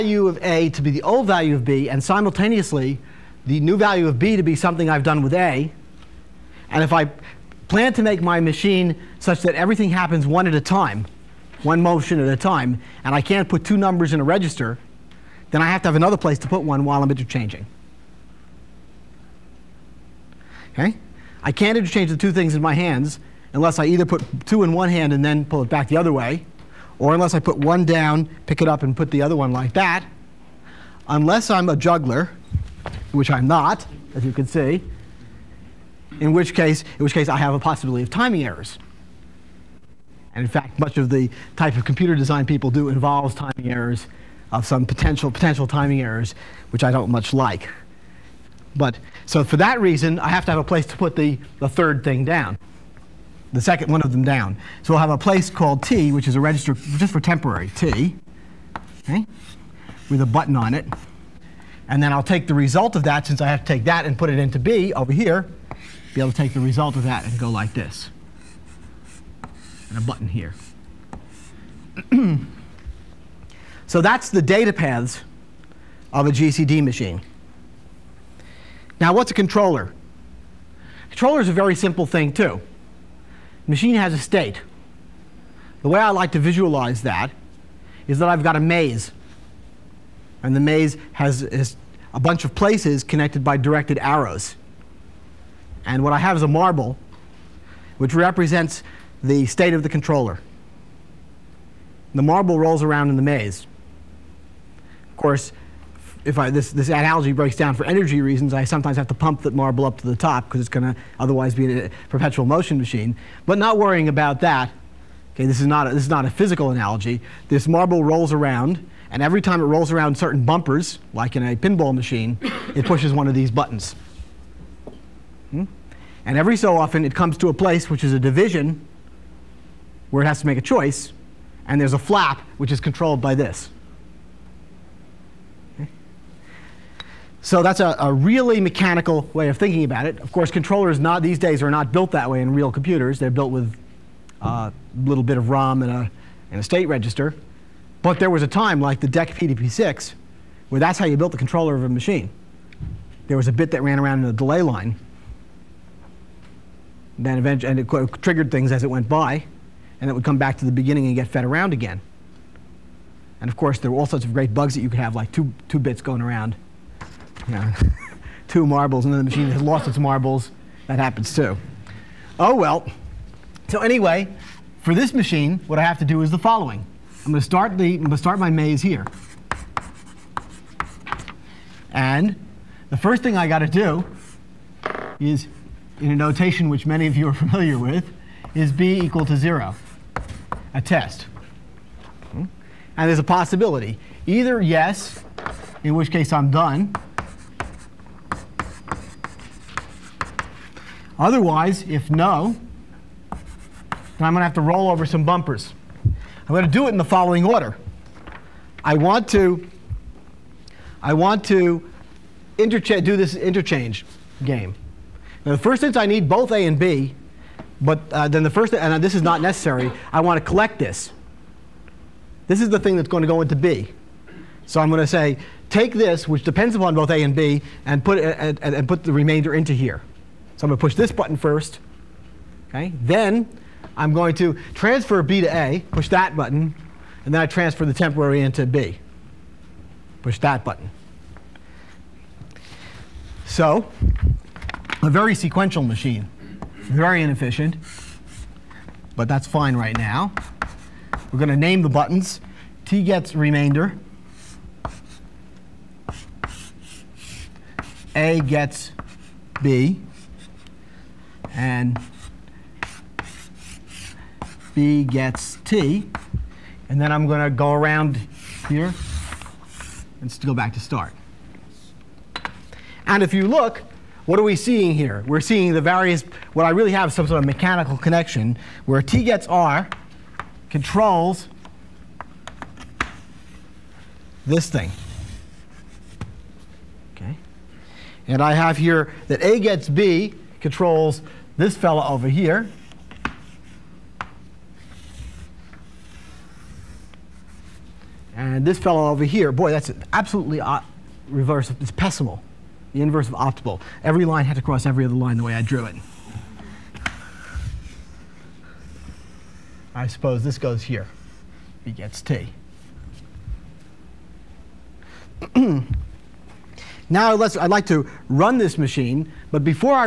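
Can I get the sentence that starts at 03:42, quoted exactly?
This is the thing that's going to go into B.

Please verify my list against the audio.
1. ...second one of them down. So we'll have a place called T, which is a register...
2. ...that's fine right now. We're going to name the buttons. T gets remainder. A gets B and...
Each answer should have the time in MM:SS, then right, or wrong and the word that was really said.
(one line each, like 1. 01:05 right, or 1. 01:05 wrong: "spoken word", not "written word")
1. 00:53 right
2. 04:09 right.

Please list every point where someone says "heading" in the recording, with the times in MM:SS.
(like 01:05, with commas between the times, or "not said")
not said.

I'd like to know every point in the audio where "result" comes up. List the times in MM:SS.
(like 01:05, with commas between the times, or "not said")
01:02, 01:06.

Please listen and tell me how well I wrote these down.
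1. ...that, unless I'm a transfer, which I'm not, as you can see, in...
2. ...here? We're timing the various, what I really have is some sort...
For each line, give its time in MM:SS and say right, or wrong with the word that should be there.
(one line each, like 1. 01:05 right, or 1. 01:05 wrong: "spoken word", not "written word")
1. 00:29 wrong: "juggler", not "transfer"
2. 04:34 wrong: "seeing", not "timing".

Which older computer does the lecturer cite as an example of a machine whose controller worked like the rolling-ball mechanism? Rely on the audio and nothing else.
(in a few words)
DEC PDP-6.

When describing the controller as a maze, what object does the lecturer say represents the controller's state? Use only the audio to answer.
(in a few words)
A marble.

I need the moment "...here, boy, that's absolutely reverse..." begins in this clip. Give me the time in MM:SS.
04:59.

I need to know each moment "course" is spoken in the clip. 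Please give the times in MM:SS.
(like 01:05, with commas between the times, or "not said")
01:45, 02:20, 02:43.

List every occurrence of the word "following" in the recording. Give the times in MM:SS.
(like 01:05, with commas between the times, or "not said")
02:56, 03:27.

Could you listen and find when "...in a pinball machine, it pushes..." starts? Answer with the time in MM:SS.
02:01.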